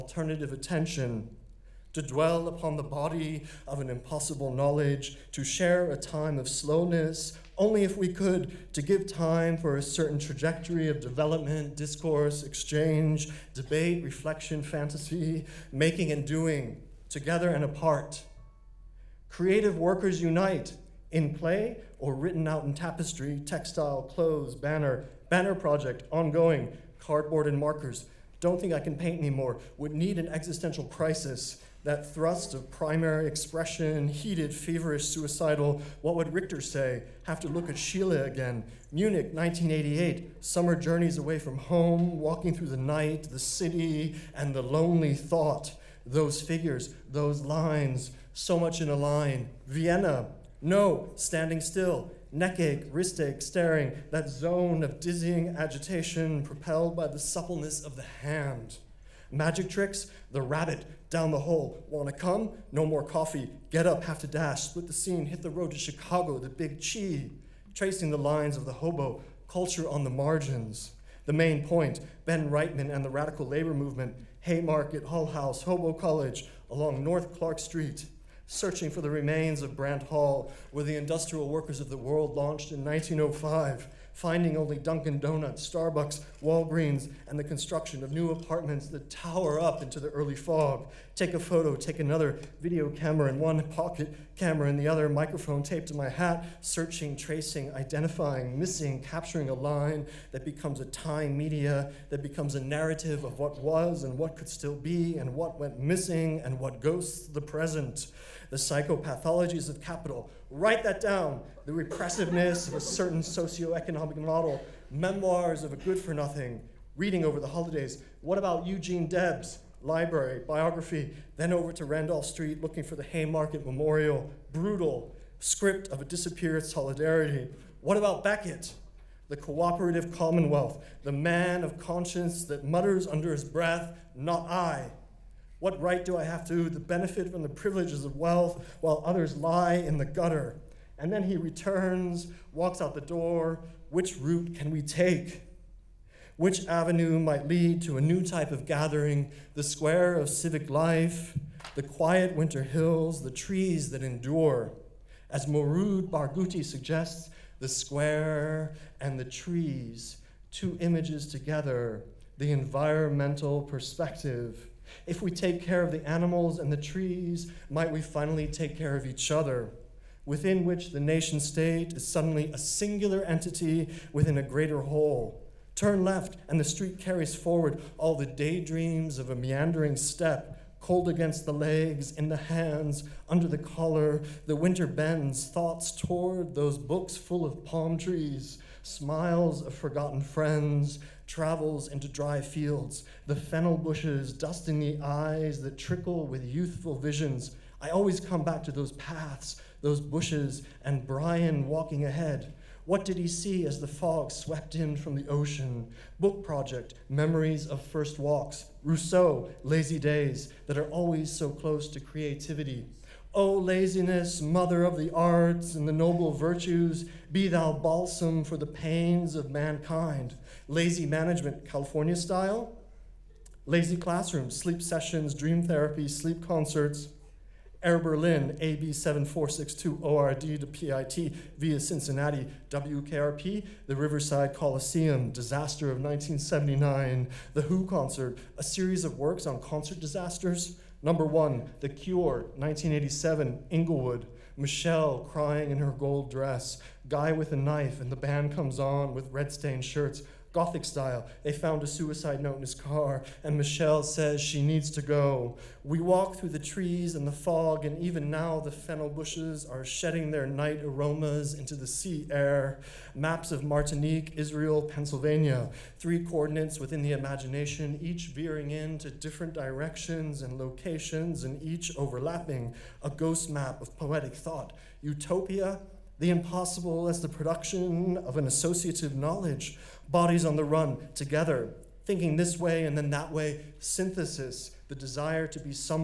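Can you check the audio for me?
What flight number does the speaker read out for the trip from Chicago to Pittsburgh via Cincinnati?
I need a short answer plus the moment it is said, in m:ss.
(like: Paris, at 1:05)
AB 7462, at 3:48.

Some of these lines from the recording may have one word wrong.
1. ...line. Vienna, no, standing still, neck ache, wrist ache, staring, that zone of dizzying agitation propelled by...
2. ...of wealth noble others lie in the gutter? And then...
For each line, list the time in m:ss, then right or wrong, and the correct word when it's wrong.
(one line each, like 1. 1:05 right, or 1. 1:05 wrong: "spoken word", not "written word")
1. 0:48 right
2. 2:18 wrong: "while", not "noble".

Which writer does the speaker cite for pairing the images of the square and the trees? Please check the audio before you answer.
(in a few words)
Mourid Barghouti.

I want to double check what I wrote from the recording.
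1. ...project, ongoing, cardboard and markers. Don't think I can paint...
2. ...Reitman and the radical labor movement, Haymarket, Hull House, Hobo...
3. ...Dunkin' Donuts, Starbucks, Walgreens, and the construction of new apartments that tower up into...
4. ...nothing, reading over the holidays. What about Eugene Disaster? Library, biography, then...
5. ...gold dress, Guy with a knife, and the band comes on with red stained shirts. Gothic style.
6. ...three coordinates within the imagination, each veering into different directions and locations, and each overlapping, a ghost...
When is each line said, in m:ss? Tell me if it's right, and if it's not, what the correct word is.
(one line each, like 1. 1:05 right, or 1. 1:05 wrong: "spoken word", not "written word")
1. 0:25 right
2. 1:12 right
3. 1:24 right
4. 1:56 wrong: "Debs", not "Disaster"
5. 4:05 right
6. 4:26 right.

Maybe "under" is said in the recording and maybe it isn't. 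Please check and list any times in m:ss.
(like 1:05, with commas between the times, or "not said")
2:13, 3:03.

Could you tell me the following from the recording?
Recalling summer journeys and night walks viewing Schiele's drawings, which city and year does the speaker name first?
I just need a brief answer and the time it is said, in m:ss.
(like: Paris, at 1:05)
Munich, 1988, at 0:38.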